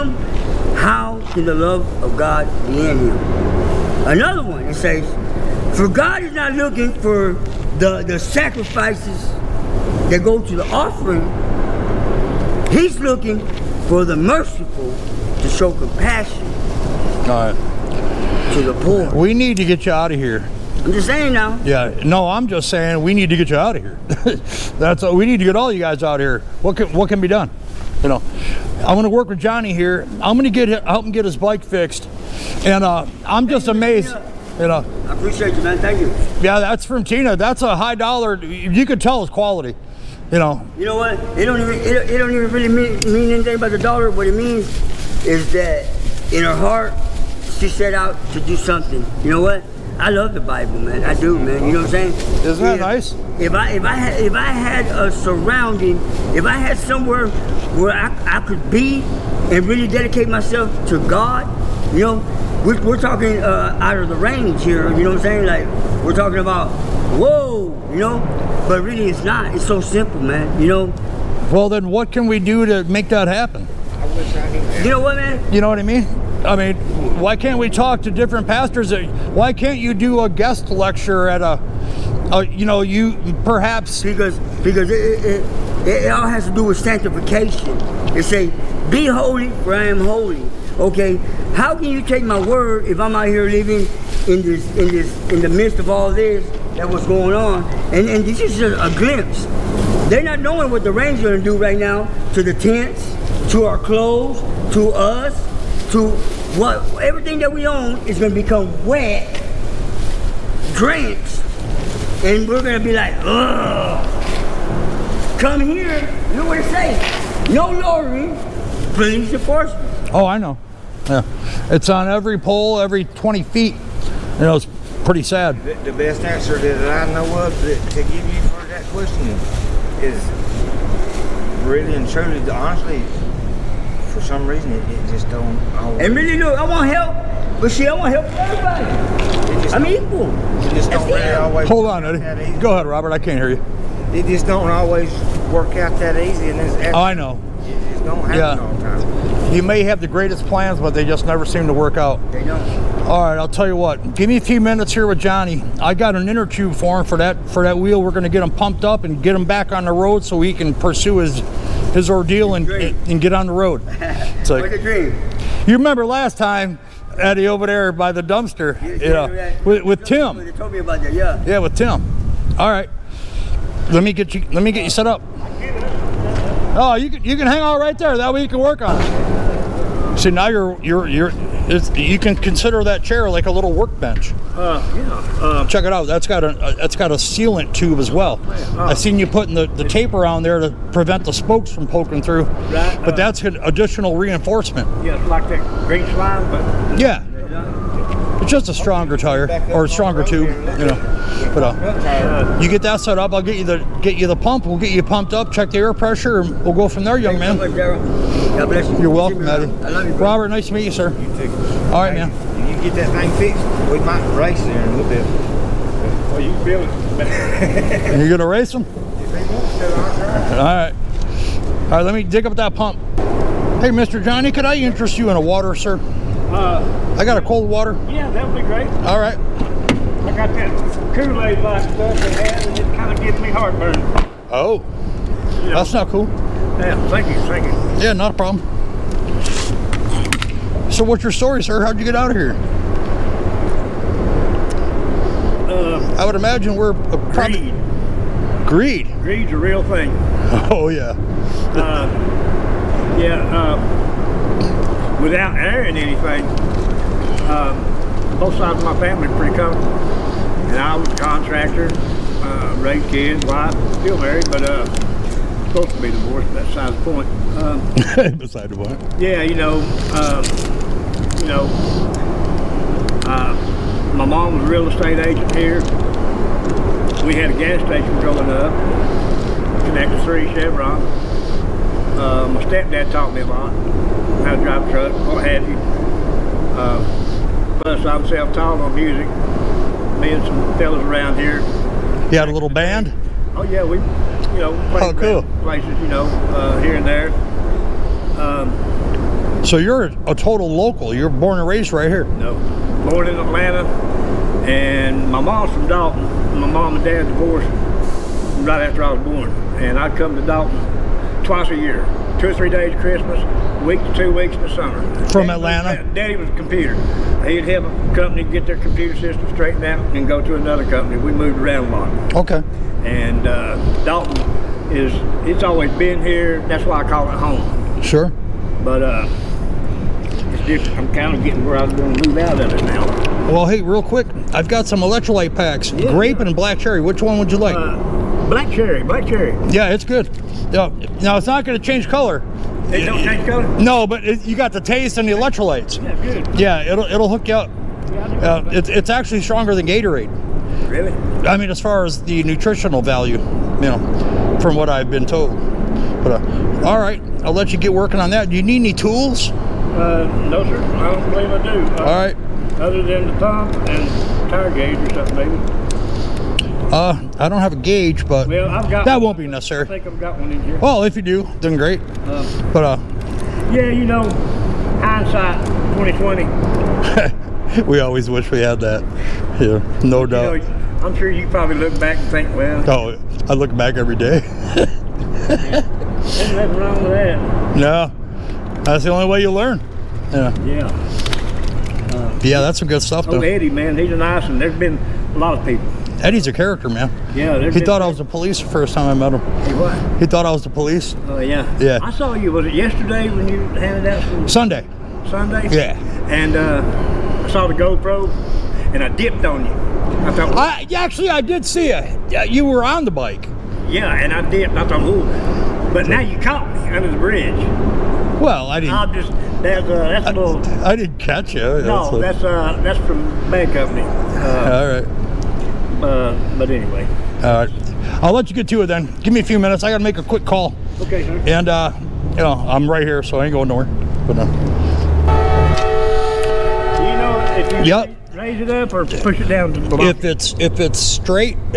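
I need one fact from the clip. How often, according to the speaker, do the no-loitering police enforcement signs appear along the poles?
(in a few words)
Every 20 feet.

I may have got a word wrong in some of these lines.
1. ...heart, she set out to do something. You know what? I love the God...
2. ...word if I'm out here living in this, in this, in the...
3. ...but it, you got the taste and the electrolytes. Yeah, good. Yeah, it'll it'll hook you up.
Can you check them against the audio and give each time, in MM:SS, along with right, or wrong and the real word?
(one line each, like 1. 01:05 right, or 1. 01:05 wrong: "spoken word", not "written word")
1. 00:46 wrong: "Bible", not "God"
2. 01:32 right
3. 05:44 right.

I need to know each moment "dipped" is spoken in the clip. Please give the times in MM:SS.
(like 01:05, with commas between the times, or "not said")
06:49, 06:54.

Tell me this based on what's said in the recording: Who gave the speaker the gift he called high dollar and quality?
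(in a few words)
Tina.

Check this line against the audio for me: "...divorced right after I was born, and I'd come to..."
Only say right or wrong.
right.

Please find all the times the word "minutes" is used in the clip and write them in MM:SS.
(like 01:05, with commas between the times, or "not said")
02:34, 07:09.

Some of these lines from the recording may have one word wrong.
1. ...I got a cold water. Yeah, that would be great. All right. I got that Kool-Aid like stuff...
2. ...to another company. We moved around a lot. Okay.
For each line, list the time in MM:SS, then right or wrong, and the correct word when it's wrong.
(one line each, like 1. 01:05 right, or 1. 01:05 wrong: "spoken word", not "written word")
1. 03:47 right
2. 05:20 right.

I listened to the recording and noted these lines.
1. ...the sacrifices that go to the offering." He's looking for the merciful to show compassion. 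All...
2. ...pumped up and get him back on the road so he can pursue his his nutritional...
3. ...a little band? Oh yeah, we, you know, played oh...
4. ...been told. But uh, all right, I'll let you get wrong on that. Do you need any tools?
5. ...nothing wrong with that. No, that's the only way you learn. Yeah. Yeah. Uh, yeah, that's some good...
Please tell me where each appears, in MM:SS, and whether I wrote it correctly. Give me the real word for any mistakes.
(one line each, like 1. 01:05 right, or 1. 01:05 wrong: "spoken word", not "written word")
1. 00:08 right
2. 02:38 wrong: "ordeal", not "nutritional"
3. 04:52 right
4. 05:55 wrong: "working", not "wrong"
5. 06:26 right.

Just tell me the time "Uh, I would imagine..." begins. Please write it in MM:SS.
04:05.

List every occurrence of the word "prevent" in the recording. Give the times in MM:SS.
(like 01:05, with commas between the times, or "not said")
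03:10.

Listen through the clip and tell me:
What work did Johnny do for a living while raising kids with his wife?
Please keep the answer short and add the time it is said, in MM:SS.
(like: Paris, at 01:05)
Contractor, at 04:21.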